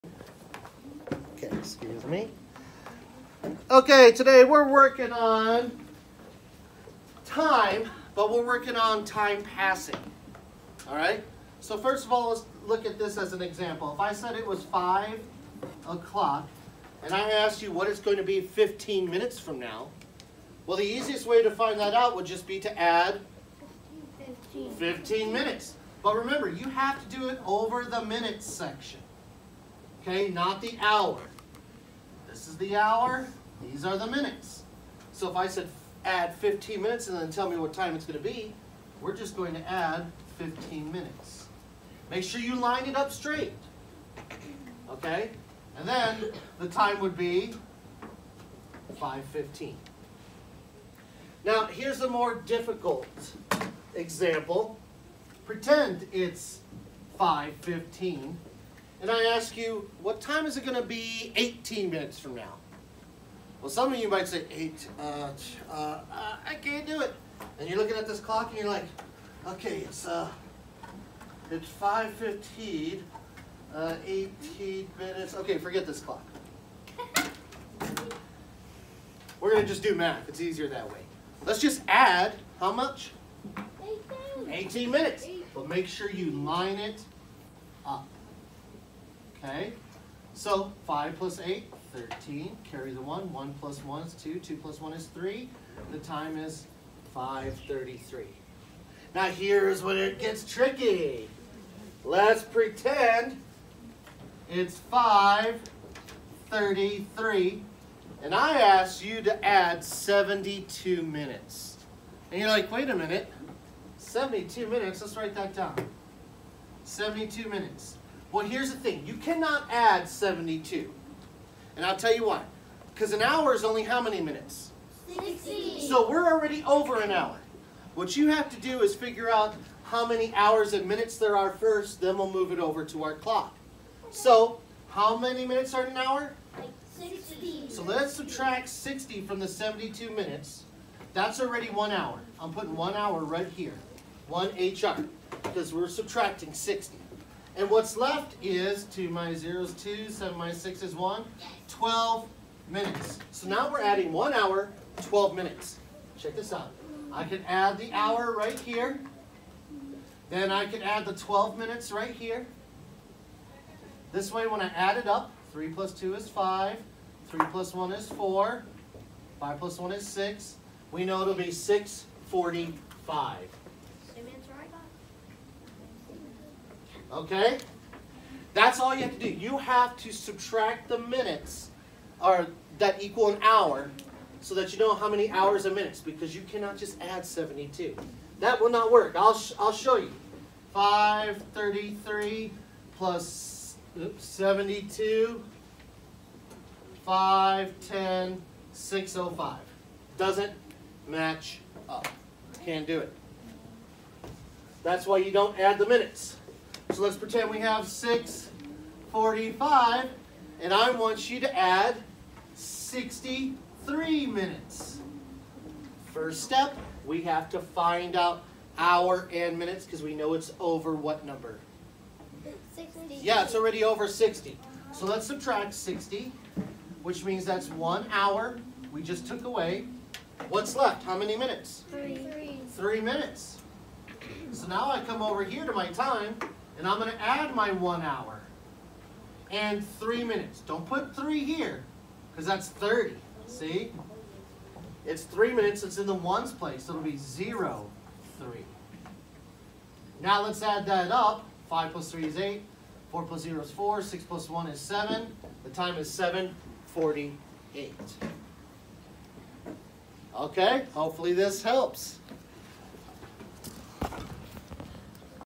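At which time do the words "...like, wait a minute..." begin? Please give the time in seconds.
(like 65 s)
112 s.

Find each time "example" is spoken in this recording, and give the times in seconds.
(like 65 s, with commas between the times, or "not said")
13 s, 53 s.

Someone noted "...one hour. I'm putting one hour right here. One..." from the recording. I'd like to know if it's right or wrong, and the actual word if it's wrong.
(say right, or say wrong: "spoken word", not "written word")
right.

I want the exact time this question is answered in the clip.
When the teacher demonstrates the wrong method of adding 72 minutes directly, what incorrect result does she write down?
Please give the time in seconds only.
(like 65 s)
198 s.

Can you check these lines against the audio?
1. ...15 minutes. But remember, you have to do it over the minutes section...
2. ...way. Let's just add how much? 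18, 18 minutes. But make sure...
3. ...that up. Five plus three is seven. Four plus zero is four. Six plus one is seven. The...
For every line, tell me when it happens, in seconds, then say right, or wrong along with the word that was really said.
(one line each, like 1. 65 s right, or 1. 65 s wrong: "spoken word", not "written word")
1. 24 s right
2. 80 s right
3. 250 s wrong: "eight", not "seven".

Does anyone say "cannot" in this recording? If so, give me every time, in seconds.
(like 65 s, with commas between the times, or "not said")
119 s, 186 s.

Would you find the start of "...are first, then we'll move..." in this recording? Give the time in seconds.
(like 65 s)
131 s.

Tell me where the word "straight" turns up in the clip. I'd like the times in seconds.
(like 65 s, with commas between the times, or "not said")
43 s.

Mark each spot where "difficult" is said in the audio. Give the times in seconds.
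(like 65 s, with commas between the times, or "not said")
52 s.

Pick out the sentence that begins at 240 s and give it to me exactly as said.
Don't put three here because that's 30.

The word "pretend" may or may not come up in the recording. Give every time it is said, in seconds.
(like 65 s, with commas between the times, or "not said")
55 s, 102 s, 207 s.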